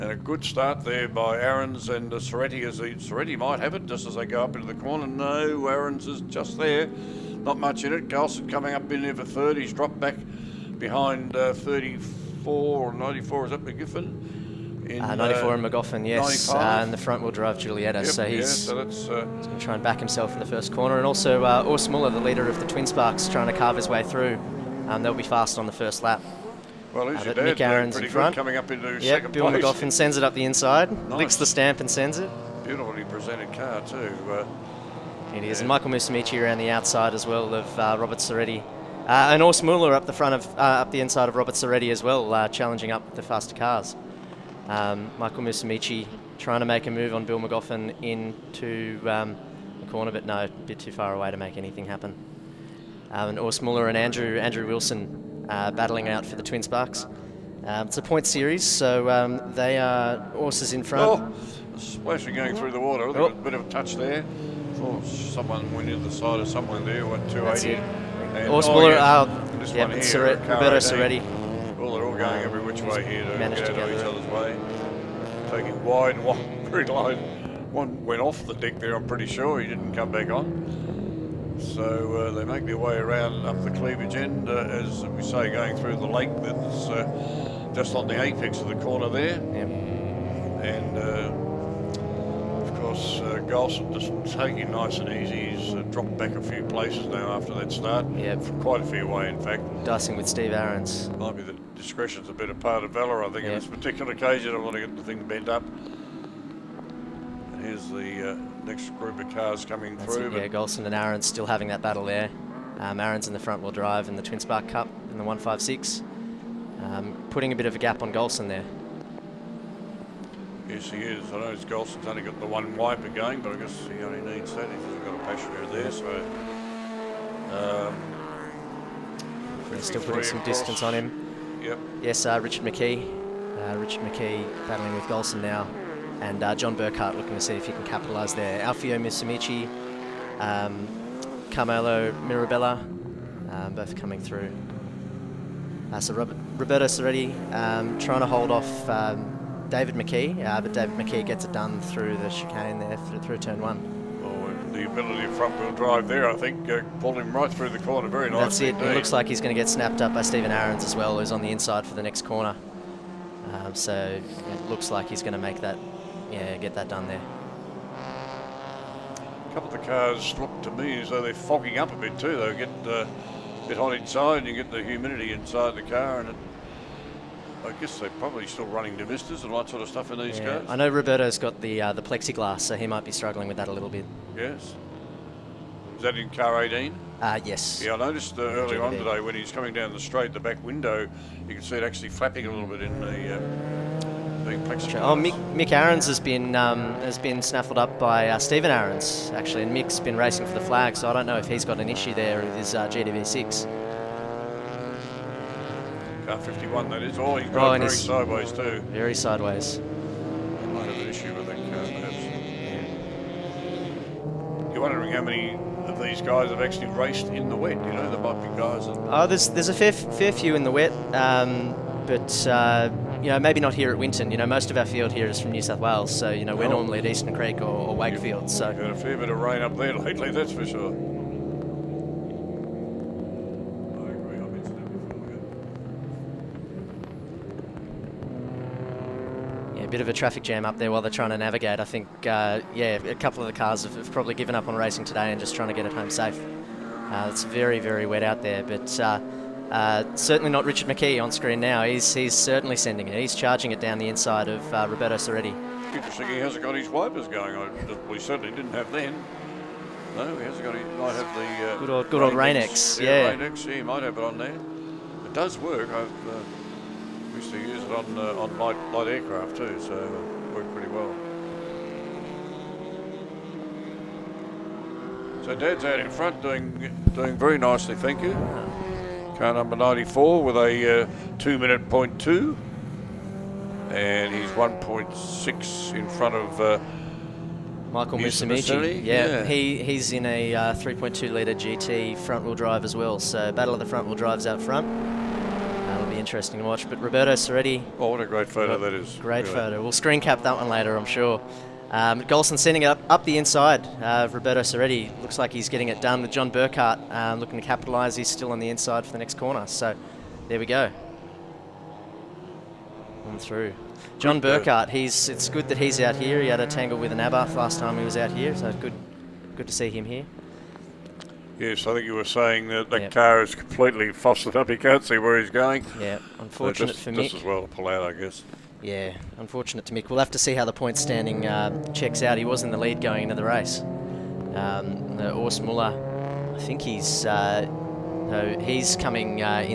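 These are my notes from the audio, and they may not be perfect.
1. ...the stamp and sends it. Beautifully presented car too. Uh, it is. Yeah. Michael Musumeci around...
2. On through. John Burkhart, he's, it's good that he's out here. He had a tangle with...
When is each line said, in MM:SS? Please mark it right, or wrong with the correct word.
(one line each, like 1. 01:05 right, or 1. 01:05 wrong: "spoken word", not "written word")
1. 00:31 right
2. 05:13 right.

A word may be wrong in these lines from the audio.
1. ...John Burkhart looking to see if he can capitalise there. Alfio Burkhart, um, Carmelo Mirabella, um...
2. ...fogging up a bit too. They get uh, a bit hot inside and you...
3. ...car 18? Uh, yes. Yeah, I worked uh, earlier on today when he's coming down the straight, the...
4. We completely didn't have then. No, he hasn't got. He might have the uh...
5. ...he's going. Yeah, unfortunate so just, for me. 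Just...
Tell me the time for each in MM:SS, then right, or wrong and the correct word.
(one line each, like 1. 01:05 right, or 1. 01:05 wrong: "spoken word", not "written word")
1. 02:16 wrong: "Musumeci", not "Burkhart"
2. 02:51 right
3. 03:06 wrong: "noticed", not "worked"
4. 04:18 wrong: "certainly", not "completely"
5. 05:25 right.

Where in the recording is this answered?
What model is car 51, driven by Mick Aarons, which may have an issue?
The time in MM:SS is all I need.
03:22.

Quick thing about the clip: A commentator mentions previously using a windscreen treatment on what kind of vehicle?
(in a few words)
light aircraft.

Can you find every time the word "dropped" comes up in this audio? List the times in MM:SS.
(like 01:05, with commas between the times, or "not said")
00:09, 01:35.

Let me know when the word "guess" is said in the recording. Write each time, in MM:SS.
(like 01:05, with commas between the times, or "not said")
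02:03, 02:57, 05:28.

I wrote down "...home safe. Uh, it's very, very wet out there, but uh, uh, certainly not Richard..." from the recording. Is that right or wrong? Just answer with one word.
right.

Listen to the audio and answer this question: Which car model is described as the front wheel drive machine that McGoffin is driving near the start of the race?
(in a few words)
Giulietta.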